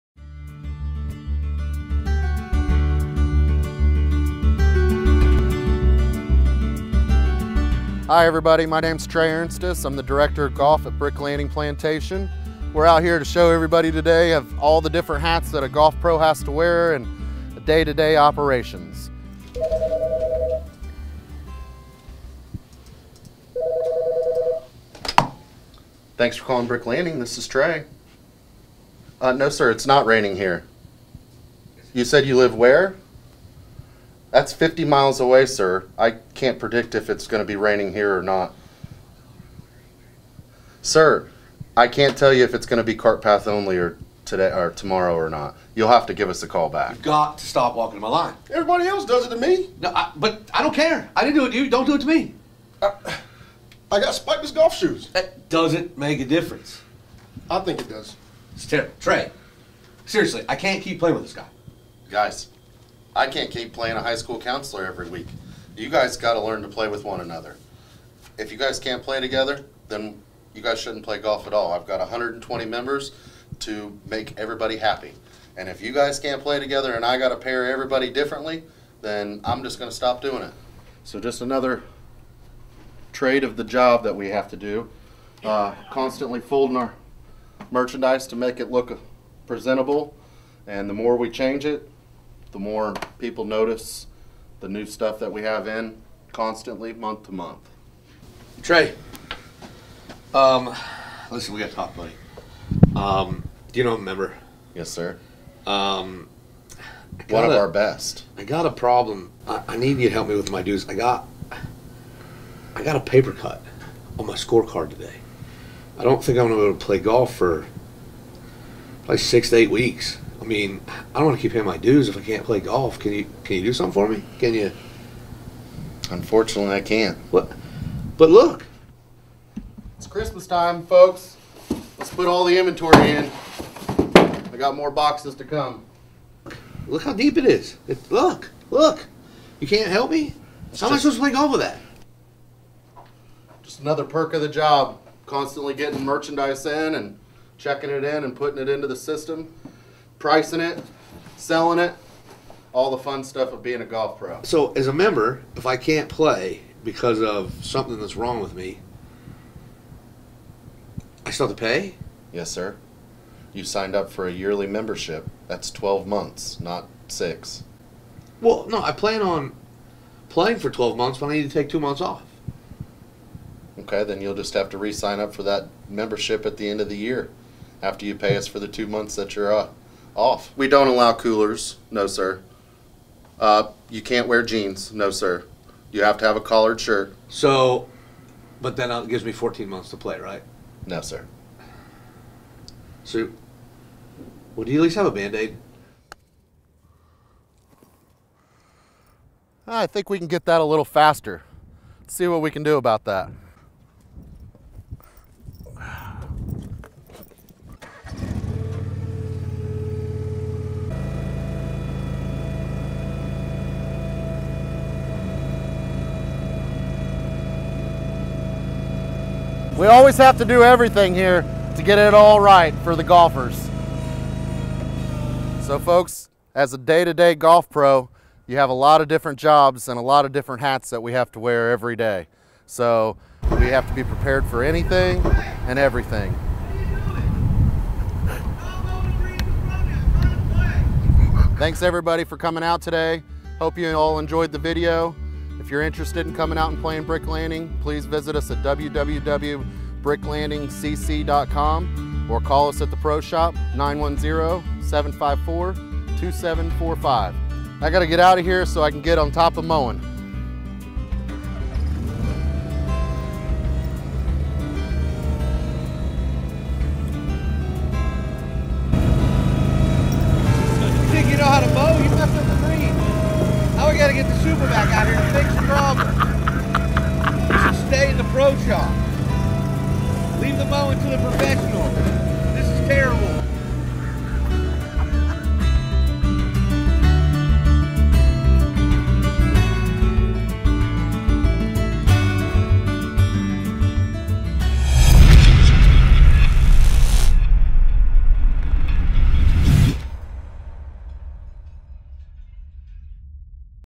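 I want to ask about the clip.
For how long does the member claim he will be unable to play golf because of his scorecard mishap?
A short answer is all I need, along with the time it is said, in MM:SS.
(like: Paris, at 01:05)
6 to 8 weeks, at 01:59.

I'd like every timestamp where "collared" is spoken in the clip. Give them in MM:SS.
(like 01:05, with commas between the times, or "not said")
03:06.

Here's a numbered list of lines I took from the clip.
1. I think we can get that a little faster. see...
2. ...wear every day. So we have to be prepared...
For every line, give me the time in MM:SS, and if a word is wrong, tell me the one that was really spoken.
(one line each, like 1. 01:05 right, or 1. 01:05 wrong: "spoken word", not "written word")
1. 03:19 right
2. 03:51 right.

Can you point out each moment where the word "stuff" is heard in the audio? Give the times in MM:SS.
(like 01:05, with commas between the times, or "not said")
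01:34, 02:33.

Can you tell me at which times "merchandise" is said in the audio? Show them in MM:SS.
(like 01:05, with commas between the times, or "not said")
01:27, 02:26.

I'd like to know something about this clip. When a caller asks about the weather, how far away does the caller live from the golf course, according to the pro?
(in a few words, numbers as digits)
50 miles.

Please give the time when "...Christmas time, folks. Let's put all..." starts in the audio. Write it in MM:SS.
02:10.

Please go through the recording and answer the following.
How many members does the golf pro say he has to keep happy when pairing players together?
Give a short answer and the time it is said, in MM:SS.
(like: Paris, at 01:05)
120, at 01:11.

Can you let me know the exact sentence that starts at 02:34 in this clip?
So, as a member, if I can't play because of something that's wrong with me, I still have to pay?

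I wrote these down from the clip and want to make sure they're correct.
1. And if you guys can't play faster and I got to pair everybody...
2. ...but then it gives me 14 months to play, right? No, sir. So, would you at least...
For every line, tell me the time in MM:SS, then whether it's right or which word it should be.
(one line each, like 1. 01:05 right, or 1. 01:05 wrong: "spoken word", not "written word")
1. 01:15 wrong: "together", not "faster"
2. 03:08 right.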